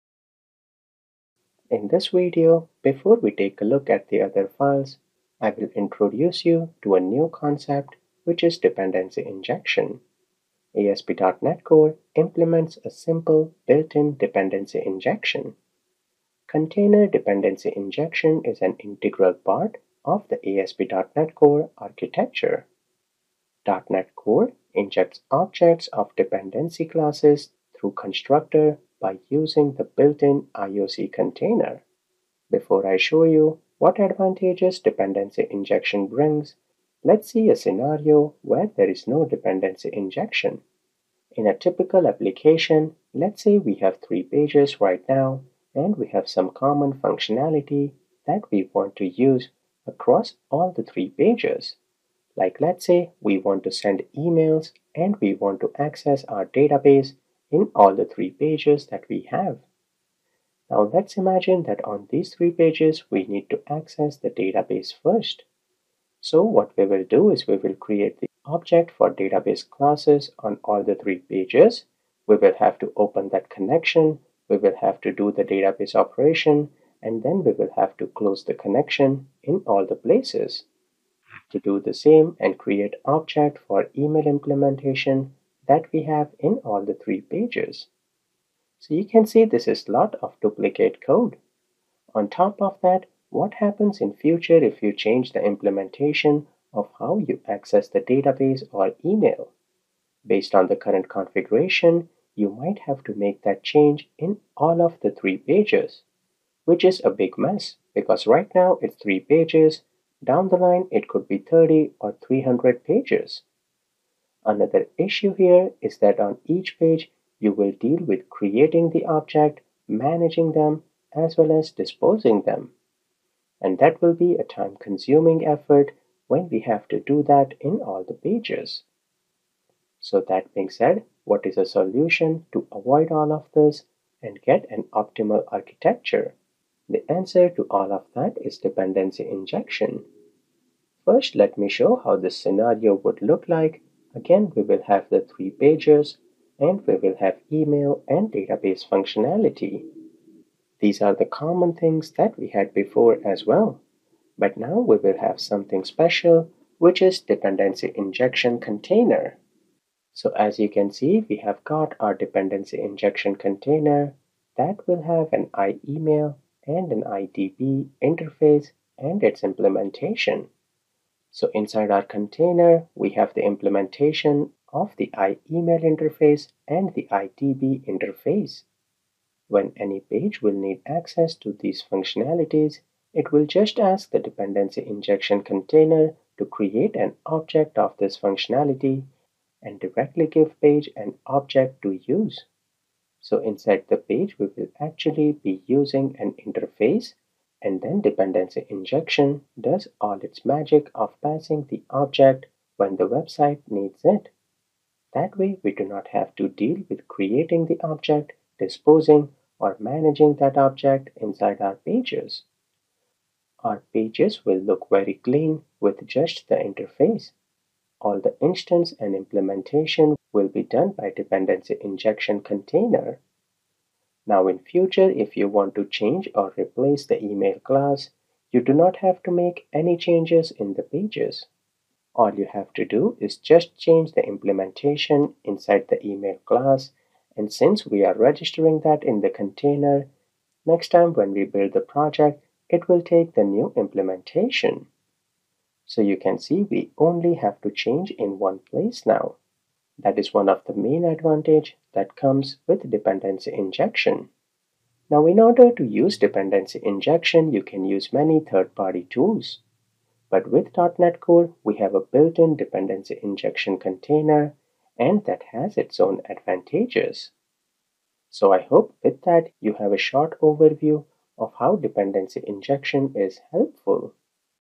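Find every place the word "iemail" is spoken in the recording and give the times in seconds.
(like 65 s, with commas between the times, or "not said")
165 s, 175 s.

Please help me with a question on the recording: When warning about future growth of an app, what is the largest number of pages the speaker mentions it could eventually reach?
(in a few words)
300.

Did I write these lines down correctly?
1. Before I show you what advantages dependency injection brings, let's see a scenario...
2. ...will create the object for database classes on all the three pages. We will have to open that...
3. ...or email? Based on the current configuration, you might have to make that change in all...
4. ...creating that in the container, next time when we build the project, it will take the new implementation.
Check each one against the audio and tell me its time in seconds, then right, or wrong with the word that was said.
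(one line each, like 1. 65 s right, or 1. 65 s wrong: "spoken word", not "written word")
1. 32 s right
2. 67 s right
3. 98 s right
4. 238 s wrong: "registering", not "creating".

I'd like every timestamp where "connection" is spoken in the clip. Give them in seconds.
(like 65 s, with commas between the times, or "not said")
73 s, 78 s.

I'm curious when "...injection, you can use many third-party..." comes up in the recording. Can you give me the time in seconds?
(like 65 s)
256 s.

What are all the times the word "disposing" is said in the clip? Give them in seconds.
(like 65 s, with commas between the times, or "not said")
121 s, 208 s.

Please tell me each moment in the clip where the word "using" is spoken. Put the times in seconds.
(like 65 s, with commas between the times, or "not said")
29 s, 195 s.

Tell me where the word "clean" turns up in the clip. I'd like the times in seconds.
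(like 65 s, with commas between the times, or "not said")
215 s.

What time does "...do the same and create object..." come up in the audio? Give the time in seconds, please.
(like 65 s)
81 s.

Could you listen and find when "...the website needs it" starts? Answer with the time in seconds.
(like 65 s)
202 s.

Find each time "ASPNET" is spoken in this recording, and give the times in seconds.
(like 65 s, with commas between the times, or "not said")
10 s, 20 s.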